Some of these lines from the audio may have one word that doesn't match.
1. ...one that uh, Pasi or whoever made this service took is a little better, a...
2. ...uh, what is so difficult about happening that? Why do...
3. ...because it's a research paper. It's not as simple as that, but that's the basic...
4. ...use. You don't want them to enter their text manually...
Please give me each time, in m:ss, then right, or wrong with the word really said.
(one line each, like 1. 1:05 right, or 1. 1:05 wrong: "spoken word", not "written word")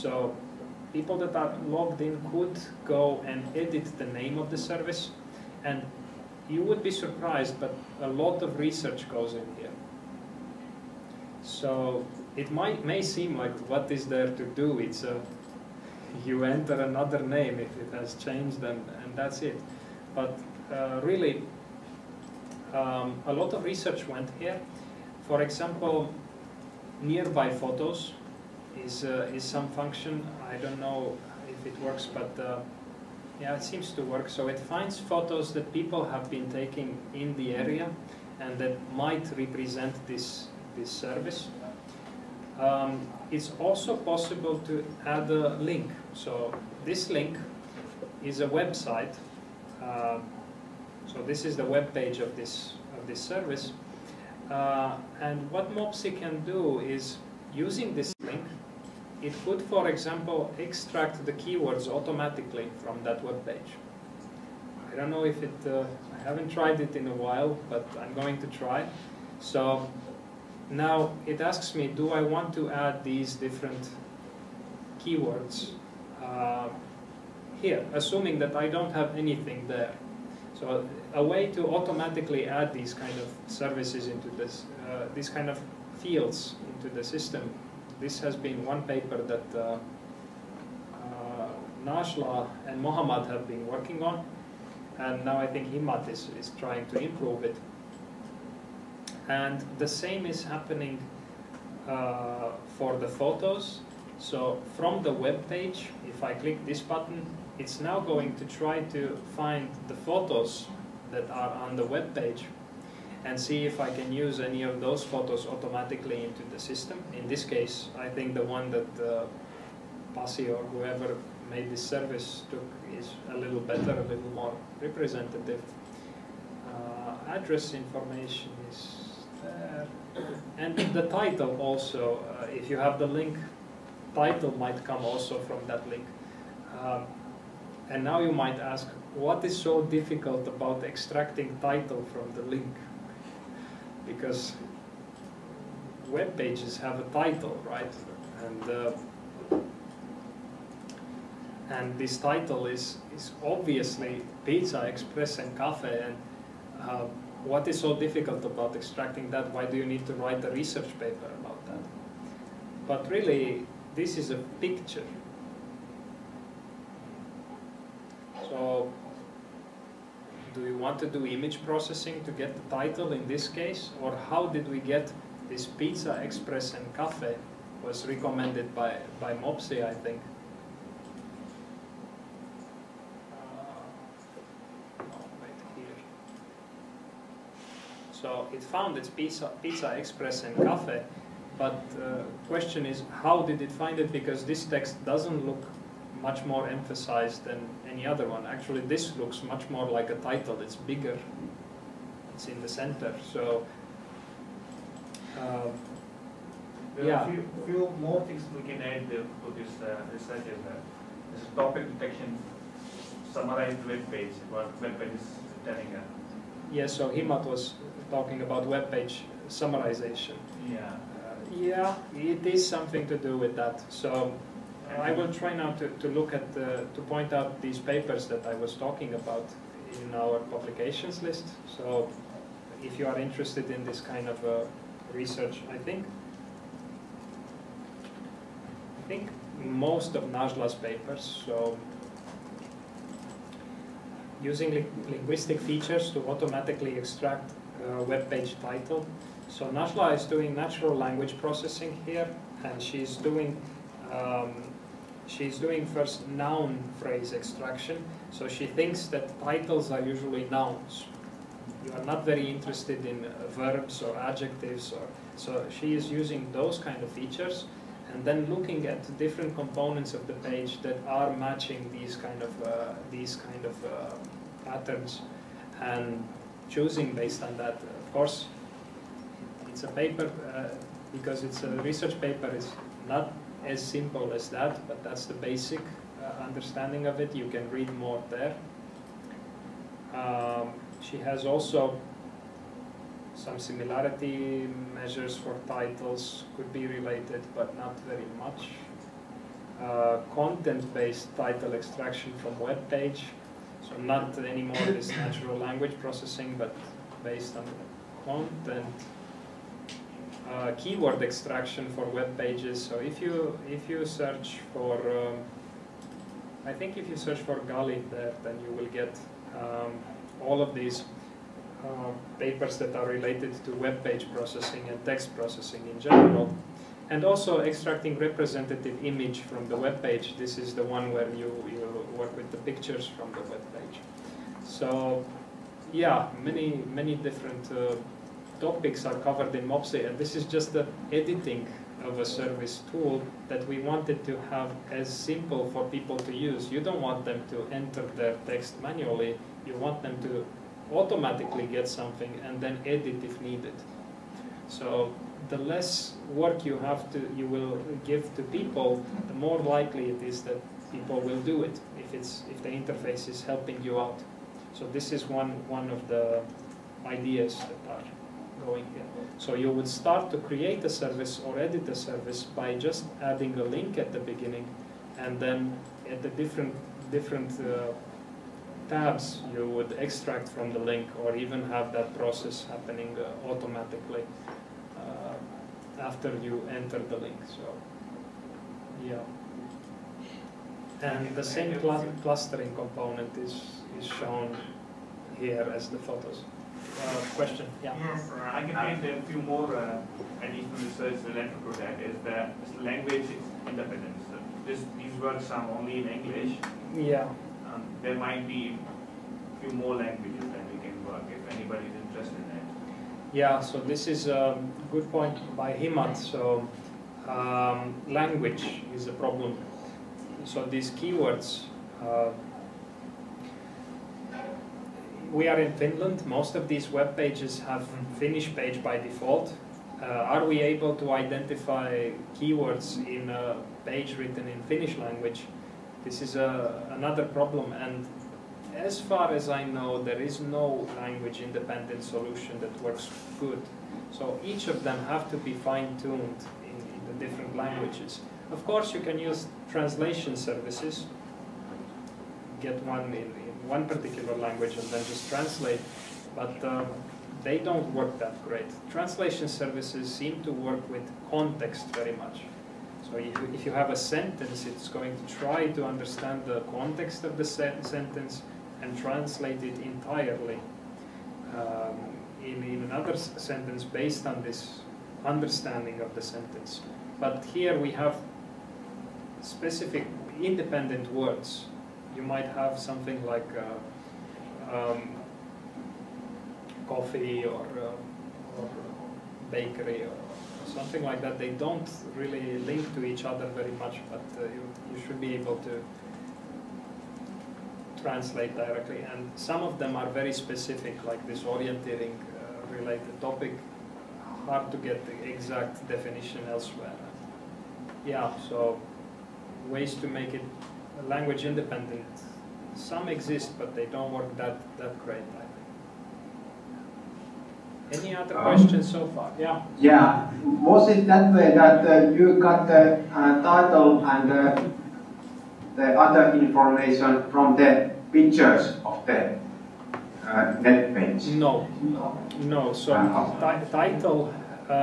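1. 1:58 right
2. 2:36 wrong: "extracting", not "happening"
3. 4:41 right
4. 5:46 right.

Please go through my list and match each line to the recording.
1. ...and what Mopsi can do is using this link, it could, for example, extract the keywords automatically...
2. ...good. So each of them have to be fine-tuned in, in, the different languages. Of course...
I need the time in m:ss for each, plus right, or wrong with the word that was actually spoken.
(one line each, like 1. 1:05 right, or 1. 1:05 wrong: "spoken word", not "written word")
1. 0:55 right
2. 7:23 right.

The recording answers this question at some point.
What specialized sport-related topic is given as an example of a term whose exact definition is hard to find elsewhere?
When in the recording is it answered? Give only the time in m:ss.
8:21.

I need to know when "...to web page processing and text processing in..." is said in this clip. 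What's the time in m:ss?
5:23.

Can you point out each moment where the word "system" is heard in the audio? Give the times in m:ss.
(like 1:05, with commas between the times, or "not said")
1:27, 1:56.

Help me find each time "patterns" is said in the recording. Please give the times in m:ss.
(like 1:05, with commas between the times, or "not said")
4:34.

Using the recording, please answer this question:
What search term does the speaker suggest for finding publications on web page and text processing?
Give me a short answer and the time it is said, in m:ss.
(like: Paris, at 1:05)
Gali, at 5:17.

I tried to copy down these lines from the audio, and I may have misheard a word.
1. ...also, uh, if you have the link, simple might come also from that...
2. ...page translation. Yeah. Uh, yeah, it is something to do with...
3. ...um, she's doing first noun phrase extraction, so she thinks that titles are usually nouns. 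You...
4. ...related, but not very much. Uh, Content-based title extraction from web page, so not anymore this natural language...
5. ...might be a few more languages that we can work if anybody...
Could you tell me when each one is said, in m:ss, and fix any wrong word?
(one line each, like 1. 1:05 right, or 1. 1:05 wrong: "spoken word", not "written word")
1. 2:11 wrong: "title", not "simple"
2. 3:38 wrong: "summarization", not "translation"
3. 4:14 right
4. 4:56 right
5. 6:48 right.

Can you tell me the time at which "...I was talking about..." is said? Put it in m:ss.
3:48.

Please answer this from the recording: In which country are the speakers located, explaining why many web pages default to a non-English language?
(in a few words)
Finland.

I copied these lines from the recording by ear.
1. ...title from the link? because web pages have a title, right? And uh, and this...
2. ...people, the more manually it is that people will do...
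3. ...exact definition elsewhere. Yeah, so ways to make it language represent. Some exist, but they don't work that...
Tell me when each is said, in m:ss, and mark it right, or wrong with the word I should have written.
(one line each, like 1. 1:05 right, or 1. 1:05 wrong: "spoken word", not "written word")
1. 2:21 right
2. 5:58 wrong: "likely", not "manually"
3. 8:25 wrong: "independent", not "represent".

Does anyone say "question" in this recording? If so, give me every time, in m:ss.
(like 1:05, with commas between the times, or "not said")
3:12, 6:37, 8:38.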